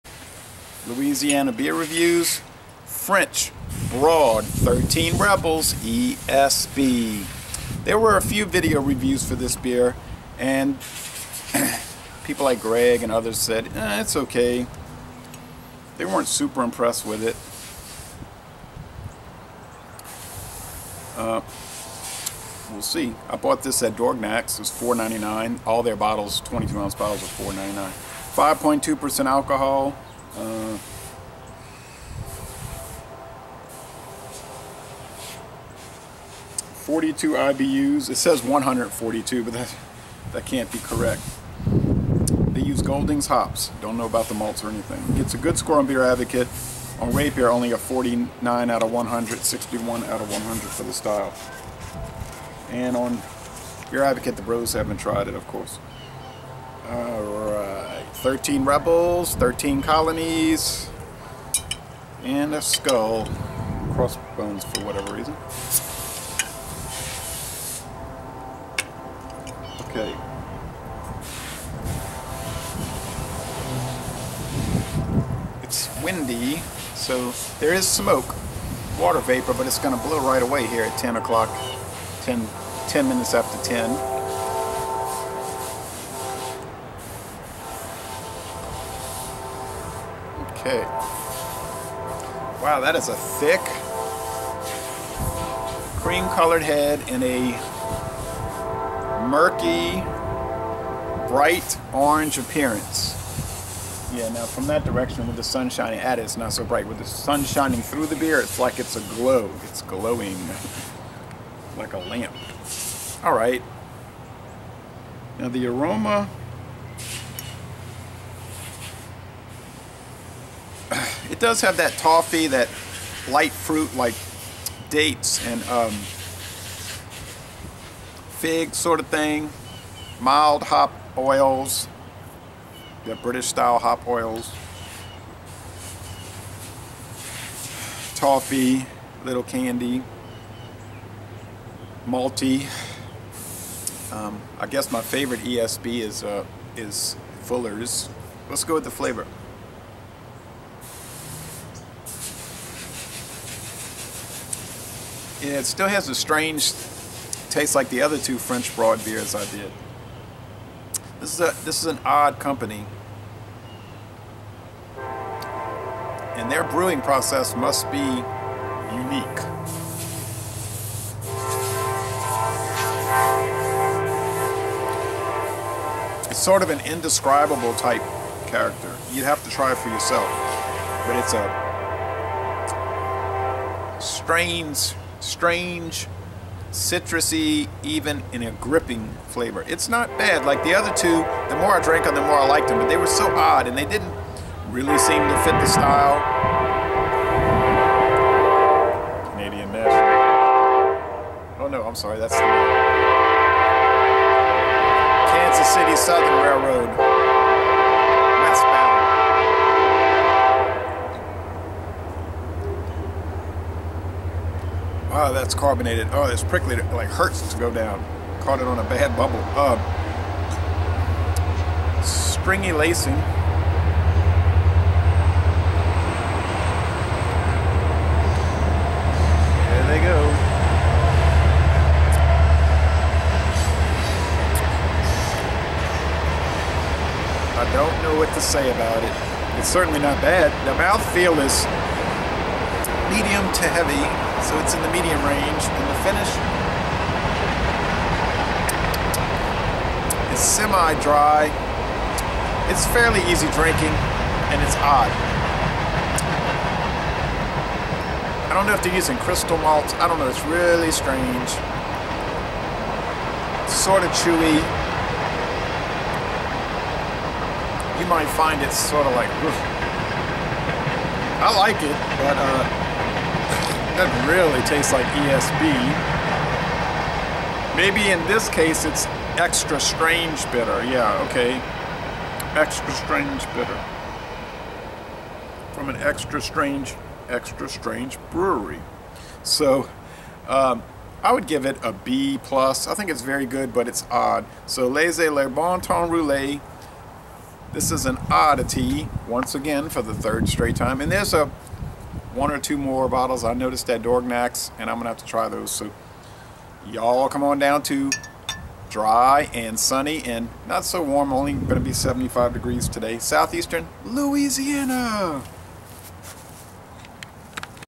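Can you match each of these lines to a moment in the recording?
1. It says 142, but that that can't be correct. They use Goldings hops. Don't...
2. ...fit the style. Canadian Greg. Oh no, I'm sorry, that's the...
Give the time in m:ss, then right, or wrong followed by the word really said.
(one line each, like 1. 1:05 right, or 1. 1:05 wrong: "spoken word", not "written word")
1. 0:38 right
2. 3:15 wrong: "National", not "Greg".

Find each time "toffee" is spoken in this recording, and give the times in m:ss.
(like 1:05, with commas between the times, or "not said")
2:01, 2:18.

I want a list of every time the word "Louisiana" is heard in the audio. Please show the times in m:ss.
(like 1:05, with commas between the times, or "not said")
0:00, 5:14.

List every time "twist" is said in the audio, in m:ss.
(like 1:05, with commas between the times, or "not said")
not said.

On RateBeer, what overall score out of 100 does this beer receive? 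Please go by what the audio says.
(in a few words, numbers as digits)
49.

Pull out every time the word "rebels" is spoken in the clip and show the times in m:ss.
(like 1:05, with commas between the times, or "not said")
0:05, 0:58.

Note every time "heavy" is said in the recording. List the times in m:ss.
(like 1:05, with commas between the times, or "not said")
4:03.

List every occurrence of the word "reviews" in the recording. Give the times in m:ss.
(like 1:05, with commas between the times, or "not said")
0:01, 0:08.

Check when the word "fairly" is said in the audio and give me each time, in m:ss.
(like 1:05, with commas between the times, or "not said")
4:12.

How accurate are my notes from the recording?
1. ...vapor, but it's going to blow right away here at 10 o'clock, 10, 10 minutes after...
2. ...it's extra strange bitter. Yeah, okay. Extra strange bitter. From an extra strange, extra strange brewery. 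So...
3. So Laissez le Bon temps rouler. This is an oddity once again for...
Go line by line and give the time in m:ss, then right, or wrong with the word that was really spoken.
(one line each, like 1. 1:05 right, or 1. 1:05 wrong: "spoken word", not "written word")
1. 1:19 right
2. 4:38 right
3. 4:54 right.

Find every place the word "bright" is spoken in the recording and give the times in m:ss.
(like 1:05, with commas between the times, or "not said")
1:41, 1:46.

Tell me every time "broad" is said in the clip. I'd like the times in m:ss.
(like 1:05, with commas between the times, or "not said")
0:03, 2:38.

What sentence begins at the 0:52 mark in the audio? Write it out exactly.
And on Beer Advocate, the bros haven't tried it, of course.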